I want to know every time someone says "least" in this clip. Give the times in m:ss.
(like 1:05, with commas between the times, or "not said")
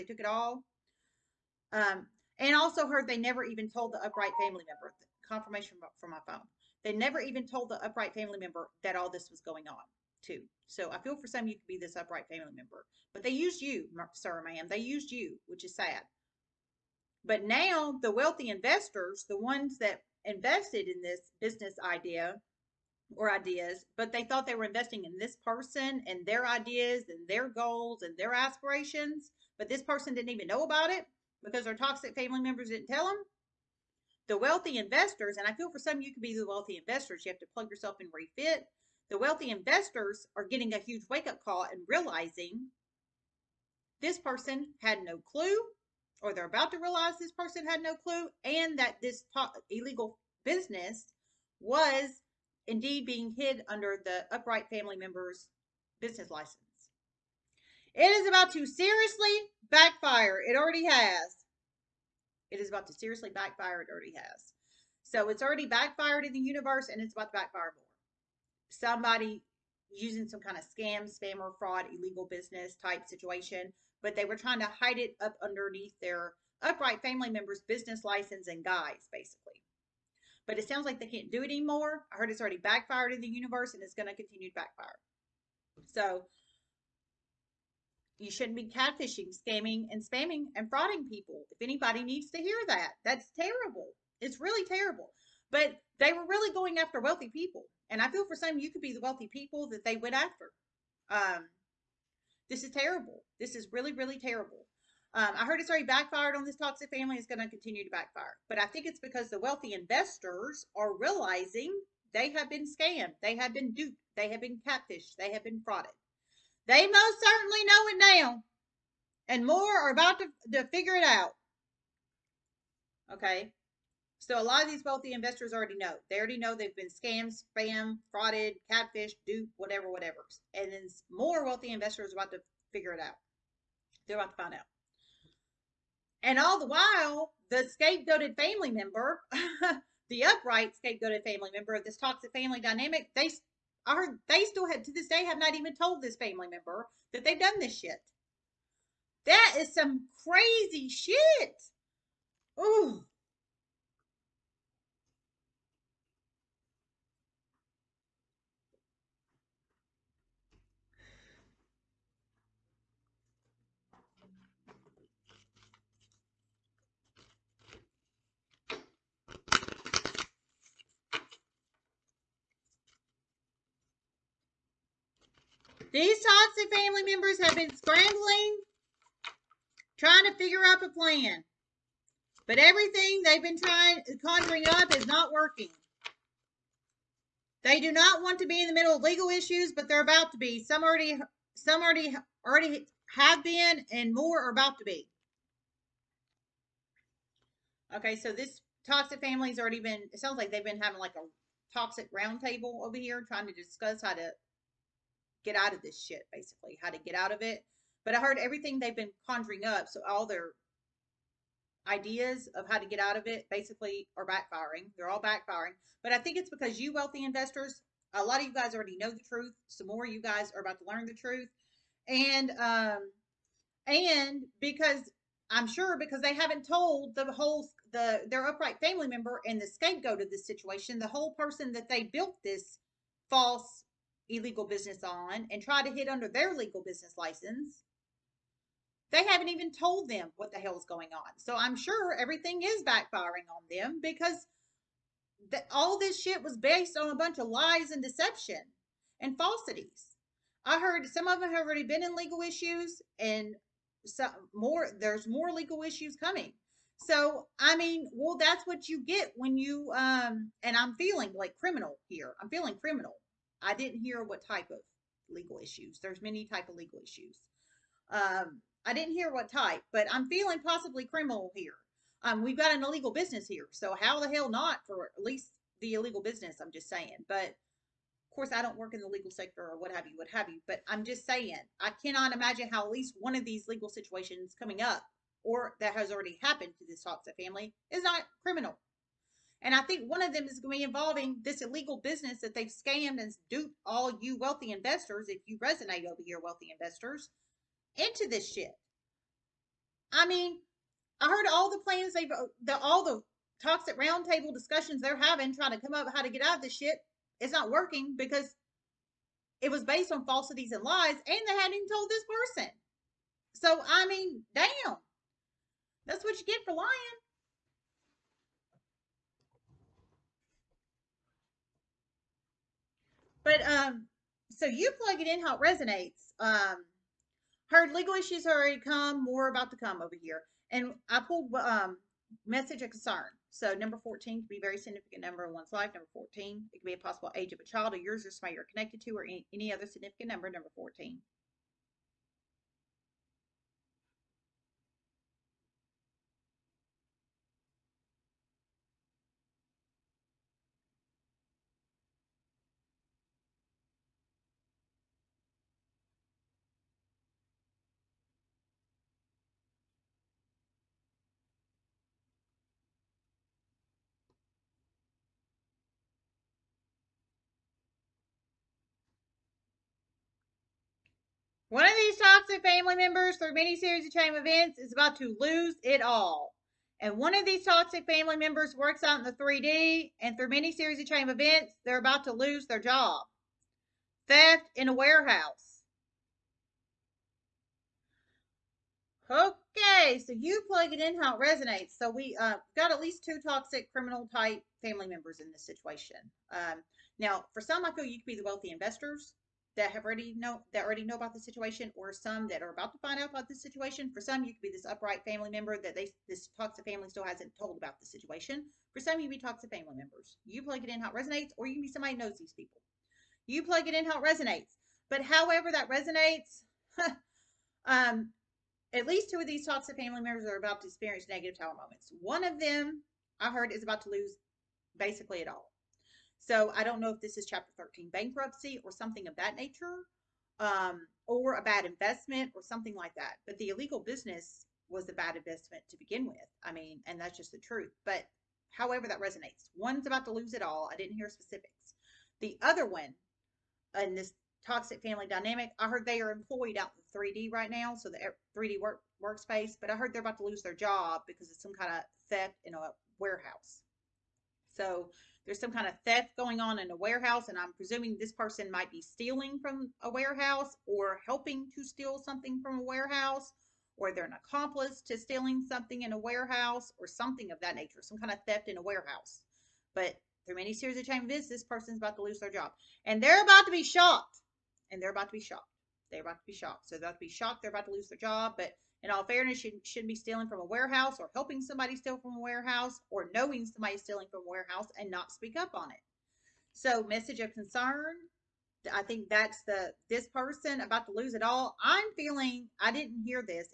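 4:35, 4:42, 6:33, 6:59.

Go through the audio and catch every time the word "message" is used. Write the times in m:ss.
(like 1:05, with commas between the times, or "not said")
5:32, 8:07.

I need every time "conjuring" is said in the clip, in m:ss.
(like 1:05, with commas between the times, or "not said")
3:04, 3:29.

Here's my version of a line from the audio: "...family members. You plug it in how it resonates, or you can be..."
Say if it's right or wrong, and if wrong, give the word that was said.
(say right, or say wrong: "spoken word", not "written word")
right.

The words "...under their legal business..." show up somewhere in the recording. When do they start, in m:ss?
3:56.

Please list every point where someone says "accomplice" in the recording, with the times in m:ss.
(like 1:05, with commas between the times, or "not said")
7:44.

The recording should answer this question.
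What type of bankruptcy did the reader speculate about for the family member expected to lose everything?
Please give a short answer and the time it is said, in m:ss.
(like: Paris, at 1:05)
Chapter 13, at 7:07.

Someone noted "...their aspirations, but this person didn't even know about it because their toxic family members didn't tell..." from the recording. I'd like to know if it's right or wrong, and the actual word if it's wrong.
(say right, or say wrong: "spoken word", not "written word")
right.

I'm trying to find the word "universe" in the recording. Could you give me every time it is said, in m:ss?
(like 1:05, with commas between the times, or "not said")
1:06, 1:23.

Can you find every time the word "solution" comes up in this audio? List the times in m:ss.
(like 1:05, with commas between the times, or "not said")
not said.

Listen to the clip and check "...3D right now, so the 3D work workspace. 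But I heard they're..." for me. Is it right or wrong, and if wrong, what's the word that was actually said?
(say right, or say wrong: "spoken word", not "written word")
right.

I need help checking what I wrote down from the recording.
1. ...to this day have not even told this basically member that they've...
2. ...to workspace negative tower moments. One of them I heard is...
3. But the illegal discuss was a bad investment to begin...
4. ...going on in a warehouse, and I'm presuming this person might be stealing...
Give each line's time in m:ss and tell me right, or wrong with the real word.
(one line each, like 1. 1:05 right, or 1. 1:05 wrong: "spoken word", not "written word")
1. 2:24 wrong: "family", not "basically"
2. 7:00 wrong: "experience", not "workspace"
3. 7:13 wrong: "business", not "discuss"
4. 7:36 right.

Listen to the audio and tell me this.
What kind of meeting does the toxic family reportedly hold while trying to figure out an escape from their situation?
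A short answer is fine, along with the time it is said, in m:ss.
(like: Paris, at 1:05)
A toxic roundtable, at 3:21.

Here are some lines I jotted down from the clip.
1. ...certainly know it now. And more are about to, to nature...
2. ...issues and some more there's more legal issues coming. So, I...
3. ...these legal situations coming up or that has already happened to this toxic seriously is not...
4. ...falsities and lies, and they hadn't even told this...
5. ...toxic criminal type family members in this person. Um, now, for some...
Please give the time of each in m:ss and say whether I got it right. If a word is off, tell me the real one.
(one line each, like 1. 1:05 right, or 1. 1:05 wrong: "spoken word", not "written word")
1. 1:57 wrong: "figure", not "nature"
2. 4:12 right
3. 4:43 wrong: "family", not "seriously"
4. 5:10 right
5. 6:33 wrong: "situation", not "person".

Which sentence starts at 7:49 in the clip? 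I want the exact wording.
But through many series of chain events, this person's about to lose their job.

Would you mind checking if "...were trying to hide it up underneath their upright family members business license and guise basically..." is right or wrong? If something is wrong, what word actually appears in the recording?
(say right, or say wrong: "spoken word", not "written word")
right.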